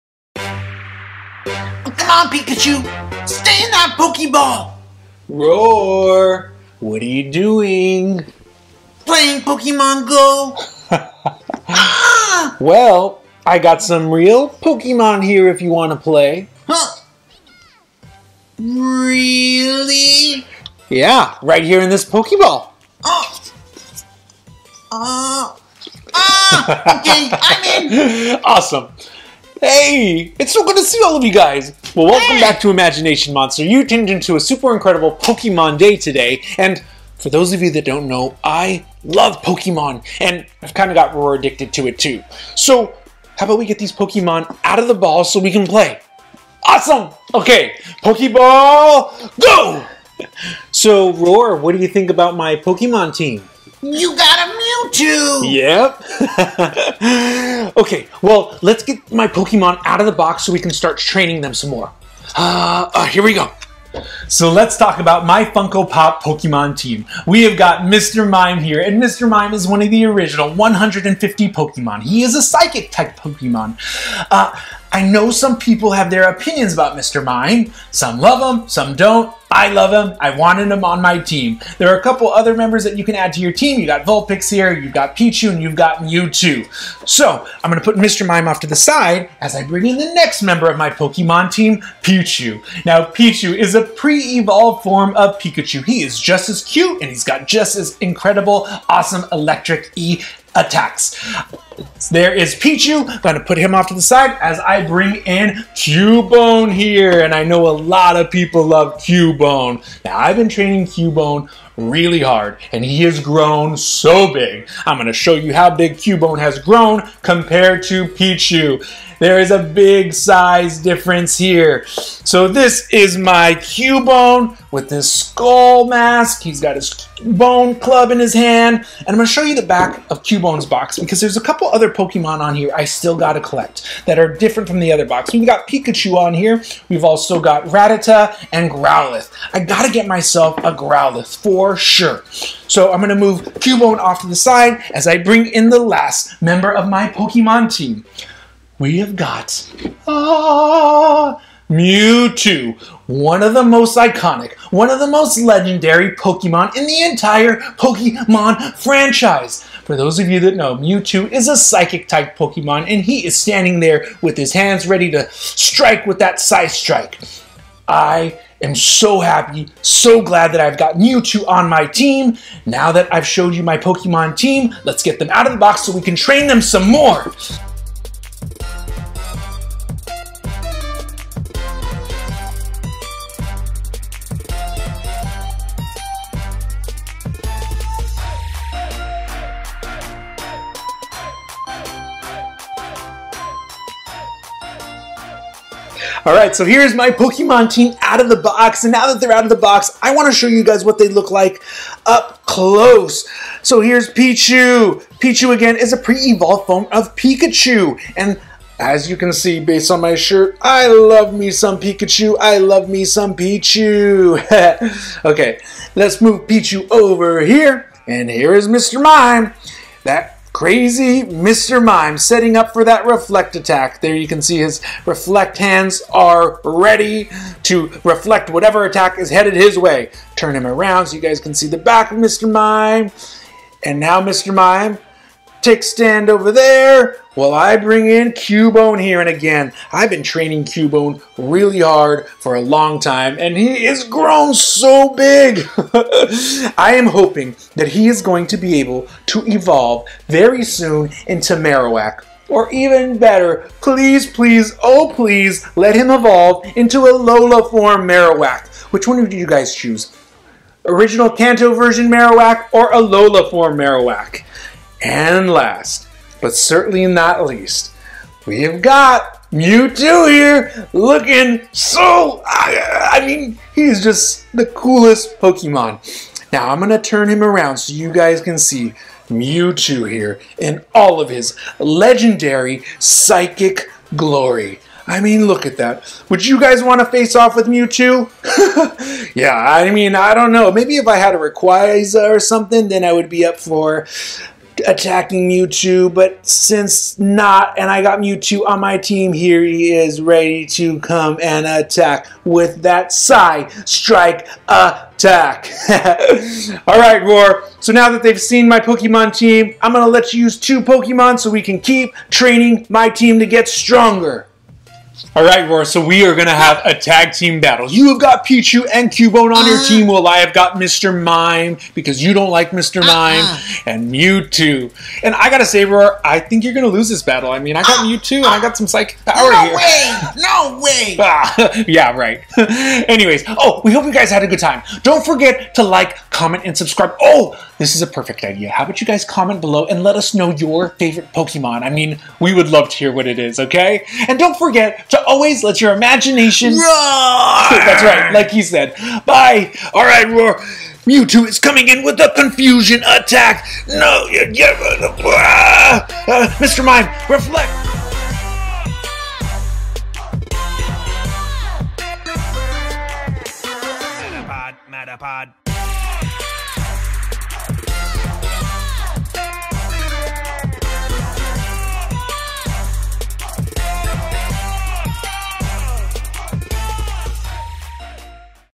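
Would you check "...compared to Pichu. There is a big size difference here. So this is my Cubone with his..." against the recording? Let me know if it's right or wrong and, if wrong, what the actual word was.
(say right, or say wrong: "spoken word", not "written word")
right.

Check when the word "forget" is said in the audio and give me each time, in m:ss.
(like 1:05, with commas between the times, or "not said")
5:35, 5:44.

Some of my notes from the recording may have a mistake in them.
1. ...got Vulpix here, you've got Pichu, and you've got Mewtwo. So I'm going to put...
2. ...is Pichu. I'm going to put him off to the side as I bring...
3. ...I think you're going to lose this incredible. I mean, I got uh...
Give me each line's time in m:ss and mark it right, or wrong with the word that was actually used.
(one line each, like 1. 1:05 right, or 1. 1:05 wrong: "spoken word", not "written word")
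1. 1:23 right
2. 1:42 right
3. 5:26 wrong: "battle", not "incredible".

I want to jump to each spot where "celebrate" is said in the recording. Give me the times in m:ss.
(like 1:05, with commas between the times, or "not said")
not said.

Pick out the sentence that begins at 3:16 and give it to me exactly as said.
All right, so here's my Pokemon team out of the box.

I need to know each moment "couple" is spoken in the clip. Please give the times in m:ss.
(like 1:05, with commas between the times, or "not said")
1:22, 2:11.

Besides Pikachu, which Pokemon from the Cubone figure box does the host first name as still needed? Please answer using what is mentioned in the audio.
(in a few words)
Rattata.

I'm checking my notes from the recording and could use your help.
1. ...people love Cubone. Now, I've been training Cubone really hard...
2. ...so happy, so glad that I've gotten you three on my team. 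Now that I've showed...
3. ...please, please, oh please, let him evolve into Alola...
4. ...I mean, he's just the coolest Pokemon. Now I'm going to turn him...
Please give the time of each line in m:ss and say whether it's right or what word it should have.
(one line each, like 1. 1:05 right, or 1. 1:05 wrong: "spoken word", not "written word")
1. 1:48 right
2. 2:48 wrong: "two", not "three"
3. 4:13 right
4. 4:33 right.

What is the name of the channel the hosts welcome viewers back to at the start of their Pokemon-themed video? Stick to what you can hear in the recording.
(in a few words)
Imagination Monster.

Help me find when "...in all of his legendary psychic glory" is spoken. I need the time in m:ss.
4:40.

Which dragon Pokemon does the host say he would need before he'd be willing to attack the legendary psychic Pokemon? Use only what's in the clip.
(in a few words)
Rayquaza.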